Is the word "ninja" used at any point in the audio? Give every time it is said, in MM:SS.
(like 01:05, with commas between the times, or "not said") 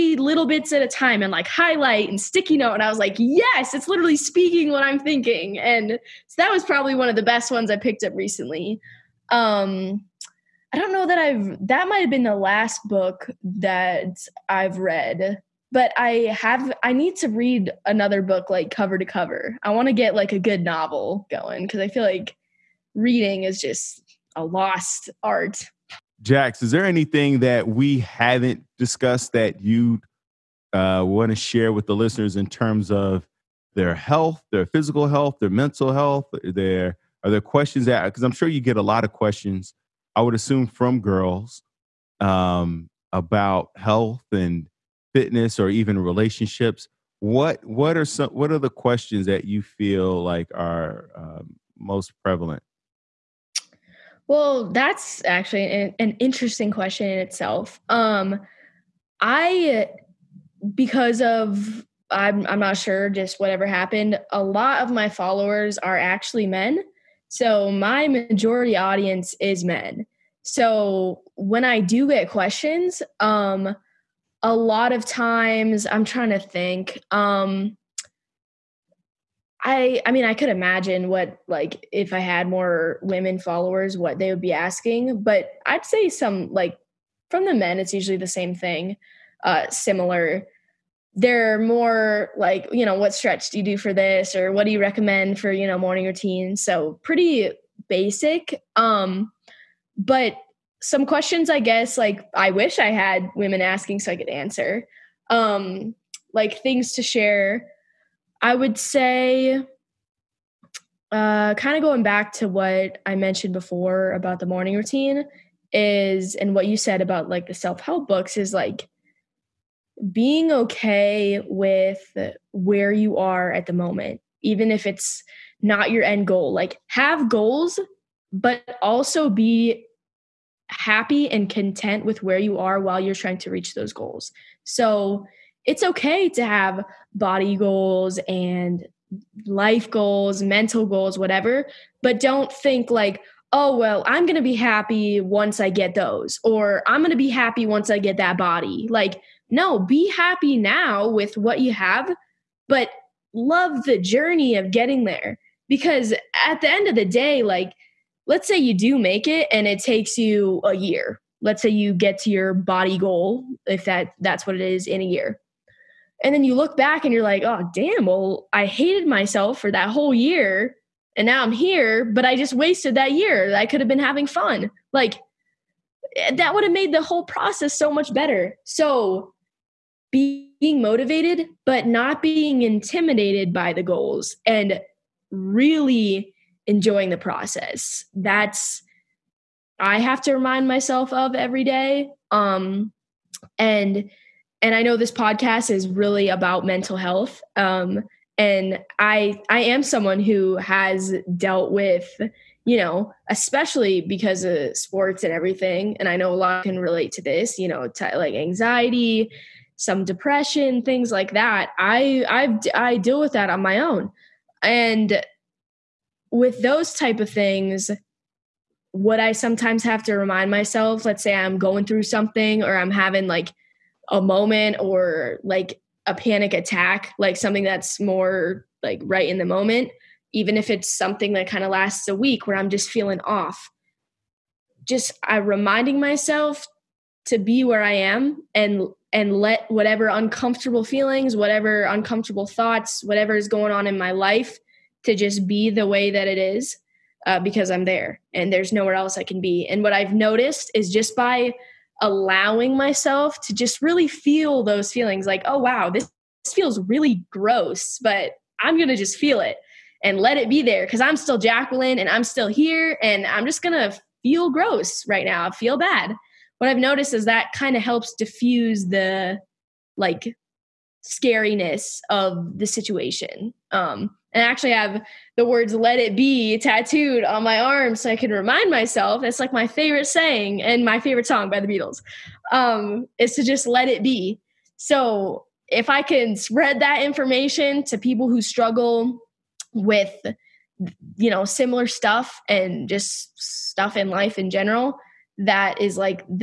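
not said.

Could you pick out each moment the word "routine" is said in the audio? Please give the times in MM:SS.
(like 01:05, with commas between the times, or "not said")
01:36, 01:54.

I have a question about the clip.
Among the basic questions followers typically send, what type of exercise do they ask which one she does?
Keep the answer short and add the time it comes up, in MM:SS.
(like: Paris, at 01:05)
stretch, at 01:33.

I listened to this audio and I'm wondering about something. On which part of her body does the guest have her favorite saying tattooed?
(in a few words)
arm.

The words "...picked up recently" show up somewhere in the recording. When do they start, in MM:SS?
00:07.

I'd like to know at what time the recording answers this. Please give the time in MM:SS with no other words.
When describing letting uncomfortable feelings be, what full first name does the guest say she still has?
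04:21.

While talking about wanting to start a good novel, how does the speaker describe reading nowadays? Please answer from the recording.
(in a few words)
a lost art.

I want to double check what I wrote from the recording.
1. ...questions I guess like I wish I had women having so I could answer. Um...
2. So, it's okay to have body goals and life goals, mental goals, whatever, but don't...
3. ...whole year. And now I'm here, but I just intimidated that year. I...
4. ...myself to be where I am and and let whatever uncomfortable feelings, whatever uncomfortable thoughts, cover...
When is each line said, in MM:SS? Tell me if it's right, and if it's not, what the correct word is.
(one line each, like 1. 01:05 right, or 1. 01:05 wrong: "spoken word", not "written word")
1. 01:41 wrong: "asking", not "having"
2. 02:14 right
3. 02:49 wrong: "wasted", not "intimidated"
4. 03:55 wrong: "whatever", not "cover".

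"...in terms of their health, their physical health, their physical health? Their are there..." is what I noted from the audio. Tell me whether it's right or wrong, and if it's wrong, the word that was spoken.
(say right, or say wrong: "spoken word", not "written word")
wrong: "mental", not "physical".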